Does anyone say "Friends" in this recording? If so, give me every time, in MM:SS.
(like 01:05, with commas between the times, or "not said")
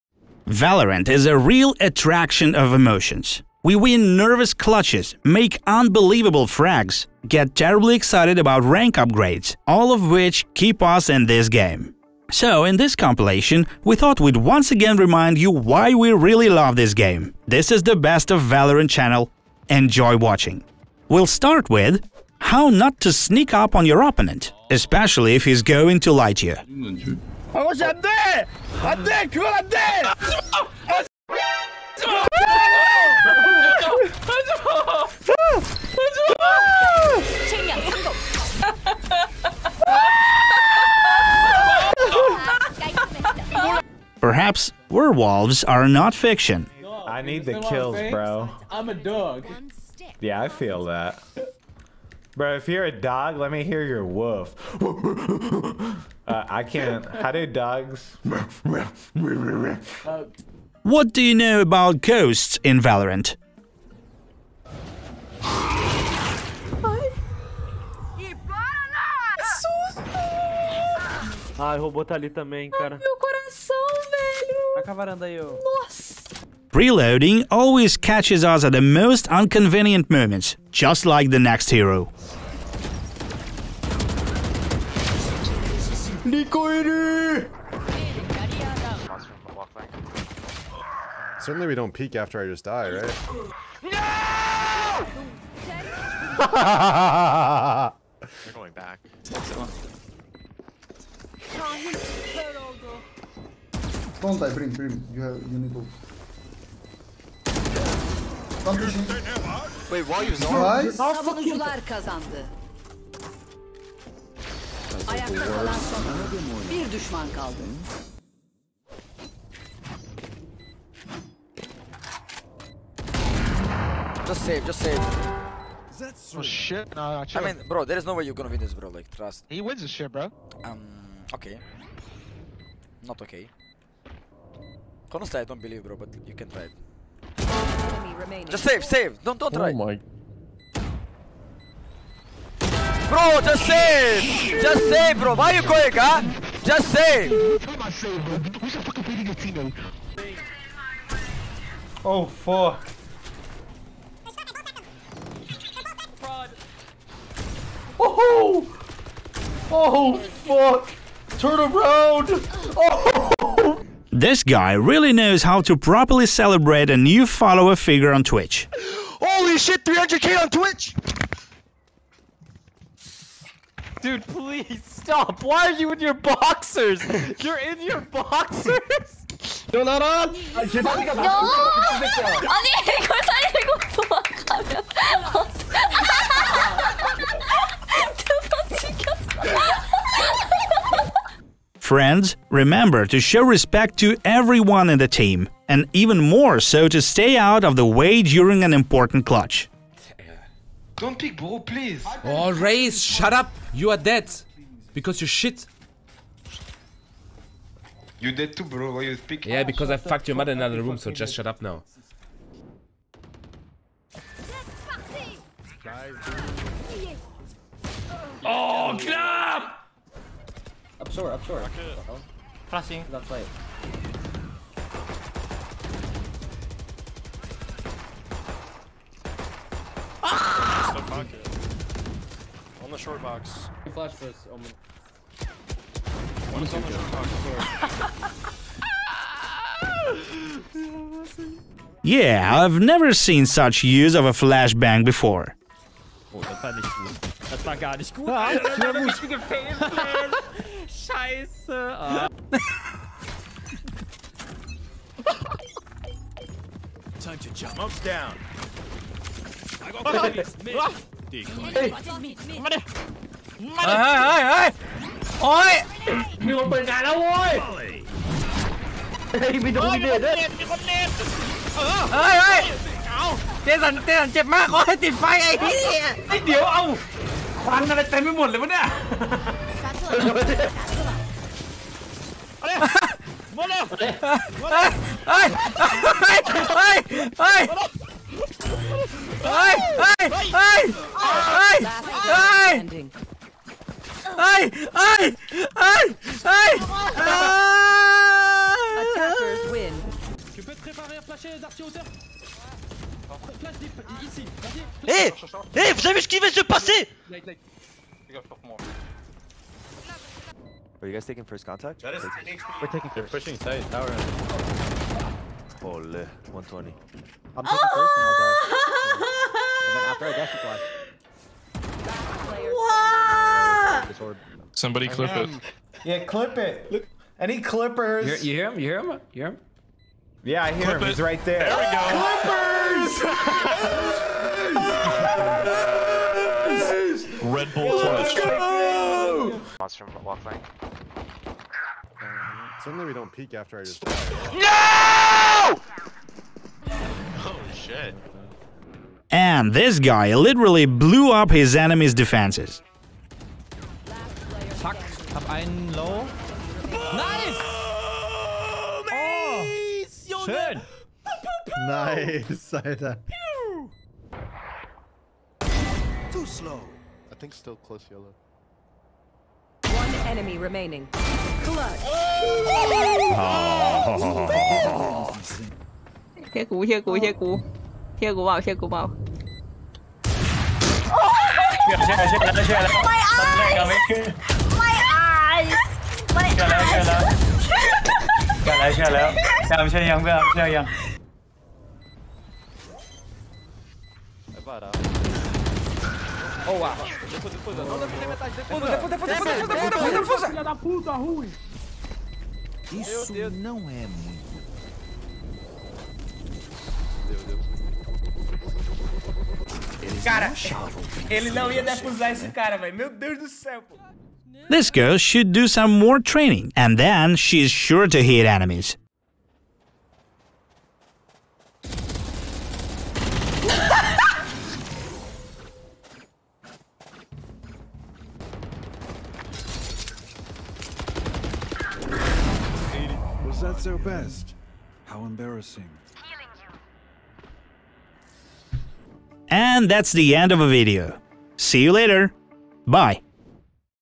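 03:11.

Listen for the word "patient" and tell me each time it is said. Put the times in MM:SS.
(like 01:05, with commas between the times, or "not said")
not said.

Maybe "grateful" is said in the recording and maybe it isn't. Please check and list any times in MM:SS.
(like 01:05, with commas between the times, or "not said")
not said.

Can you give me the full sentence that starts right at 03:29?
Yeah, because I fucked your mother in another room, so just shut up now.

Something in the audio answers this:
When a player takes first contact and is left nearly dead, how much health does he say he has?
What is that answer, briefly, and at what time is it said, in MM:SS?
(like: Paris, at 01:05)
10 HP, at 05:12.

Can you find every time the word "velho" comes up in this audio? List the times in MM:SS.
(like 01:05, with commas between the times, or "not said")
01:14, 06:52.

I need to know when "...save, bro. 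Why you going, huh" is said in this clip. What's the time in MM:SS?
02:24.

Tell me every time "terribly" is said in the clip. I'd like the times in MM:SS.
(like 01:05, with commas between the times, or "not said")
00:07.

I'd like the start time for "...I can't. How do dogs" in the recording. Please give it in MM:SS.
00:56.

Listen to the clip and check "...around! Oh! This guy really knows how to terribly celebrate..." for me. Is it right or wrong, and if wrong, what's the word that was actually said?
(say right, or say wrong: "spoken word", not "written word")
wrong: "properly", not "terribly".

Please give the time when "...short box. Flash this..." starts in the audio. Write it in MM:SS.
03:52.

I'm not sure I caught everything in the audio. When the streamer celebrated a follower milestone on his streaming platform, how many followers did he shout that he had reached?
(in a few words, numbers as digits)
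300k.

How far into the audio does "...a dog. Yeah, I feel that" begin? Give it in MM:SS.
00:48.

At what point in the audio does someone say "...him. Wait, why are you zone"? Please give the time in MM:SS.
01:48.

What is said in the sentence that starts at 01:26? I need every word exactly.
Nico い る Certainly we don't peek after I just die, right?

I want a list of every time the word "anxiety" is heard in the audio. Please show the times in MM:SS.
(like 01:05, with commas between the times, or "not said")
not said.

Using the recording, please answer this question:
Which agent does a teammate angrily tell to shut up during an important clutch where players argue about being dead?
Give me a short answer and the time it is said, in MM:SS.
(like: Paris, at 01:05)
Raze, at 03:22.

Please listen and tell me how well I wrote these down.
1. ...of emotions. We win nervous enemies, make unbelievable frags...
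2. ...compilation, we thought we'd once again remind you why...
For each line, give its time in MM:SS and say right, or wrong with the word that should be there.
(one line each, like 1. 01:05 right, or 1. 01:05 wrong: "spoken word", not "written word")
1. 00:02 wrong: "clutches", not "enemies"
2. 00:12 right.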